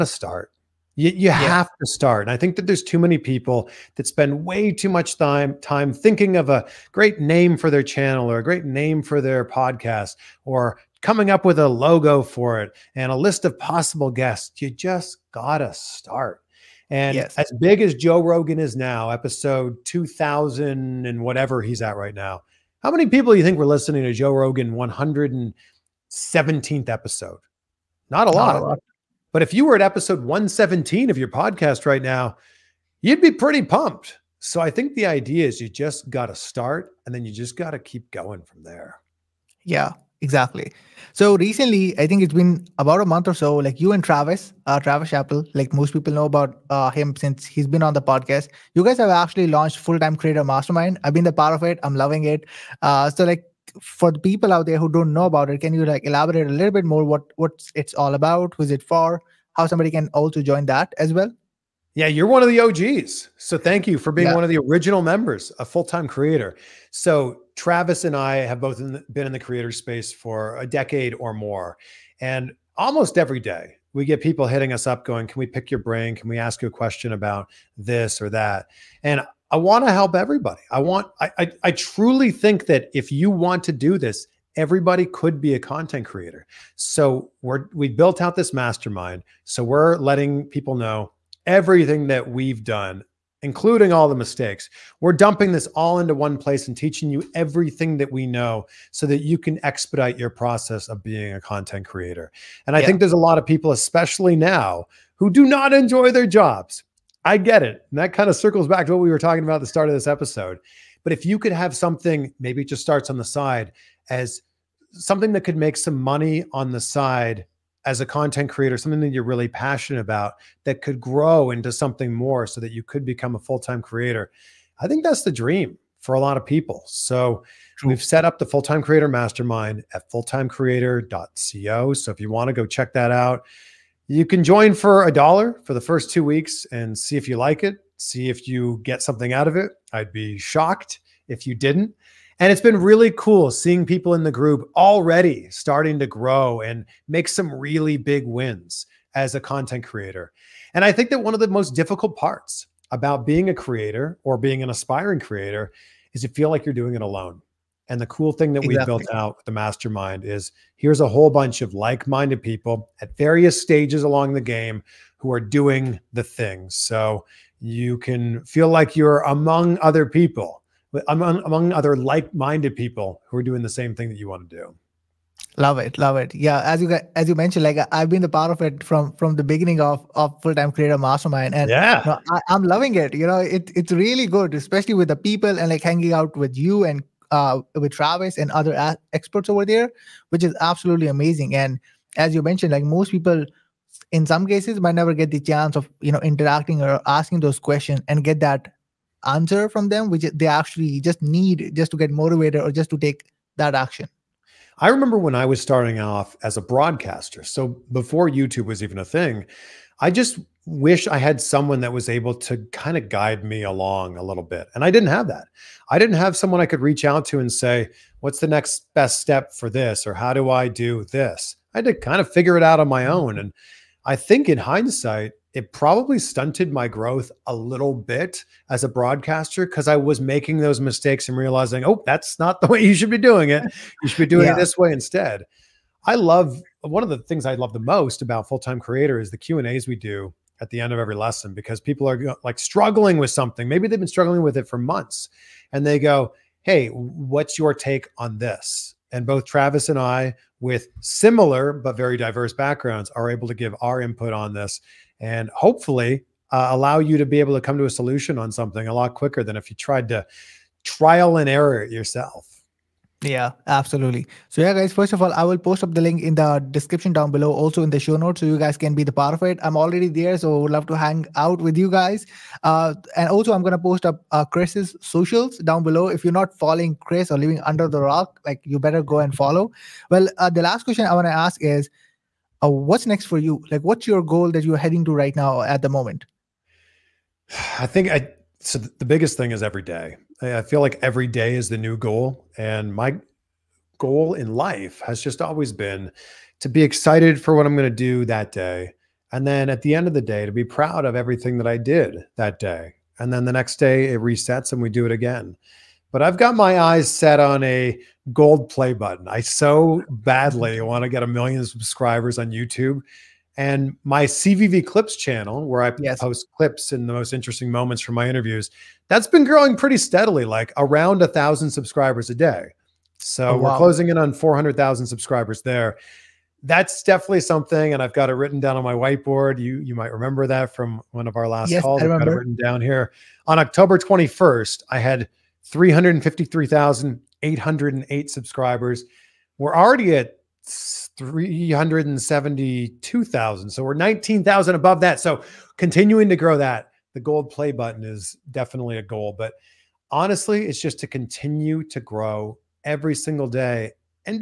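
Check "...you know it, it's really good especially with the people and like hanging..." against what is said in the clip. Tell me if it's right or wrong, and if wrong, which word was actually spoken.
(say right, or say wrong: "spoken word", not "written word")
right.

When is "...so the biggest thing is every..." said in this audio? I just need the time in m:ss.
4:48.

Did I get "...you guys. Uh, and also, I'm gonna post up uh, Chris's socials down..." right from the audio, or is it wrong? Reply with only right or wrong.
right.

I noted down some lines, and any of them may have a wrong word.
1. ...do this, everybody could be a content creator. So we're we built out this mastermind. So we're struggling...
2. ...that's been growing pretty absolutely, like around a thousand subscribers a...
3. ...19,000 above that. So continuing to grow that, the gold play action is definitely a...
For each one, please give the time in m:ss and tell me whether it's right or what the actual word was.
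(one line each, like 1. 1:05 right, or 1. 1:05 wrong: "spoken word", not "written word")
1. 1:23 wrong: "letting", not "struggling"
2. 5:19 wrong: "steadily", not "absolutely"
3. 5:43 wrong: "button", not "action".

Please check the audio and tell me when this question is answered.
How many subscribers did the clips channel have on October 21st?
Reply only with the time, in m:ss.
5:35.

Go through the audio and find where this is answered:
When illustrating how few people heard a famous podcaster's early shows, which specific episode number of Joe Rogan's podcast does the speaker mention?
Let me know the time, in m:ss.
0:24.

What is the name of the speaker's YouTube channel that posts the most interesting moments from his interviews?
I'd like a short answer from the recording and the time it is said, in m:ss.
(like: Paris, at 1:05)
CVV Clips, at 5:14.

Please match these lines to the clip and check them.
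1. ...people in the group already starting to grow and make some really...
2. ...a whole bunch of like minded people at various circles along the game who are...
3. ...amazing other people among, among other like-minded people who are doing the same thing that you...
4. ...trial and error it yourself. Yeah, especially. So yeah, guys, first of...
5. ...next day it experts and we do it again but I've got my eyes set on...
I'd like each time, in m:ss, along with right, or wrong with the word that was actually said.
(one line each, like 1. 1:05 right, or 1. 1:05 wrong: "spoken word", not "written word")
1. 2:23 right
2. 2:41 wrong: "stages", not "circles"
3. 2:49 wrong: "among", not "amazing"
4. 4:20 wrong: "absolutely", not "especially"
5. 5:03 wrong: "resets", not "experts".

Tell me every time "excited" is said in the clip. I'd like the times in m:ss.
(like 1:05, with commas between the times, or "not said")
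4:56.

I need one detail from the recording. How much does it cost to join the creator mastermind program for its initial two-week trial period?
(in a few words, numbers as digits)
a dollar.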